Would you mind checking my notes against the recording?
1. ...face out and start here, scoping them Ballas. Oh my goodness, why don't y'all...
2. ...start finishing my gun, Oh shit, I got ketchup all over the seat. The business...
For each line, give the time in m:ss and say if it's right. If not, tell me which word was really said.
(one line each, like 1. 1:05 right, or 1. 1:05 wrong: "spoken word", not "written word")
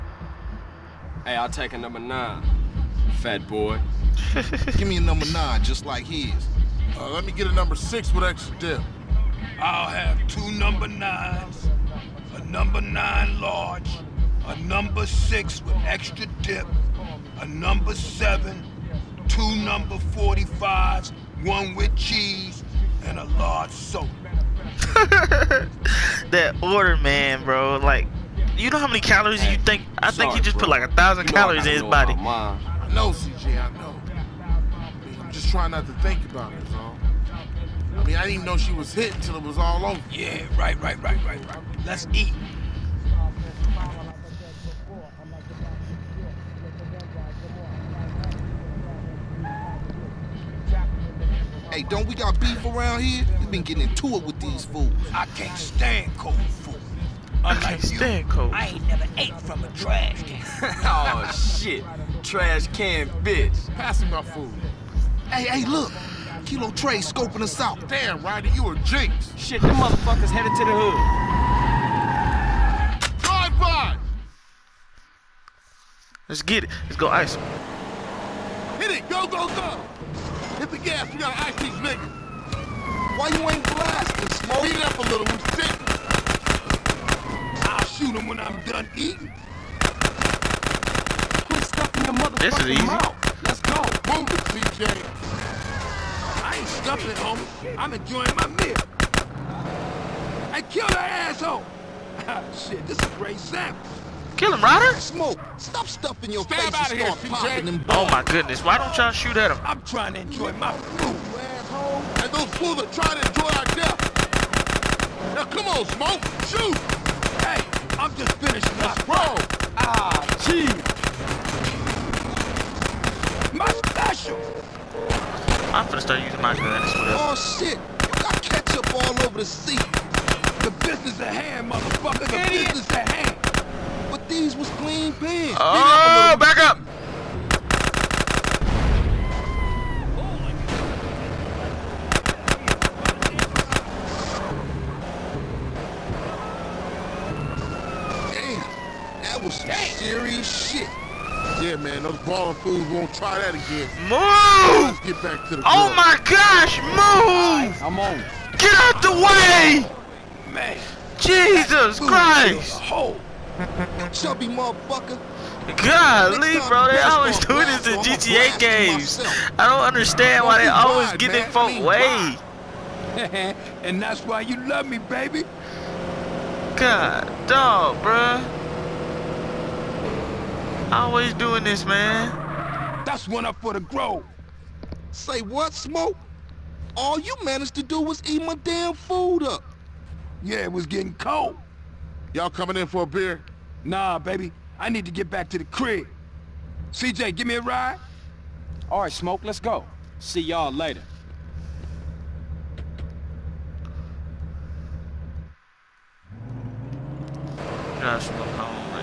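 1. 1:46 wrong: "popping", not "scoping"
2. 2:06 wrong: "using", not "finishing".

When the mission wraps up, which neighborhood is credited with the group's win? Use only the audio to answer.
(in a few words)
the Grove.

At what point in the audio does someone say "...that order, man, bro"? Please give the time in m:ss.
0:26.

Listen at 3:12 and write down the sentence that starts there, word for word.
Y'all coming in for a beer?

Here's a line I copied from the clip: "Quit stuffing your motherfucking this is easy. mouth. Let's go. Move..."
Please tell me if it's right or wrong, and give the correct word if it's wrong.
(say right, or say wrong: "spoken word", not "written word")
right.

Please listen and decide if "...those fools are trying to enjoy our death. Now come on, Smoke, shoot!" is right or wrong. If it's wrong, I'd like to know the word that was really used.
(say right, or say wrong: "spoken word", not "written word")
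right.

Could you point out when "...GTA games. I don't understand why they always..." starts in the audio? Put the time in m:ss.
2:47.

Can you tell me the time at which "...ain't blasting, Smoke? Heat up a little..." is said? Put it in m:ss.
1:23.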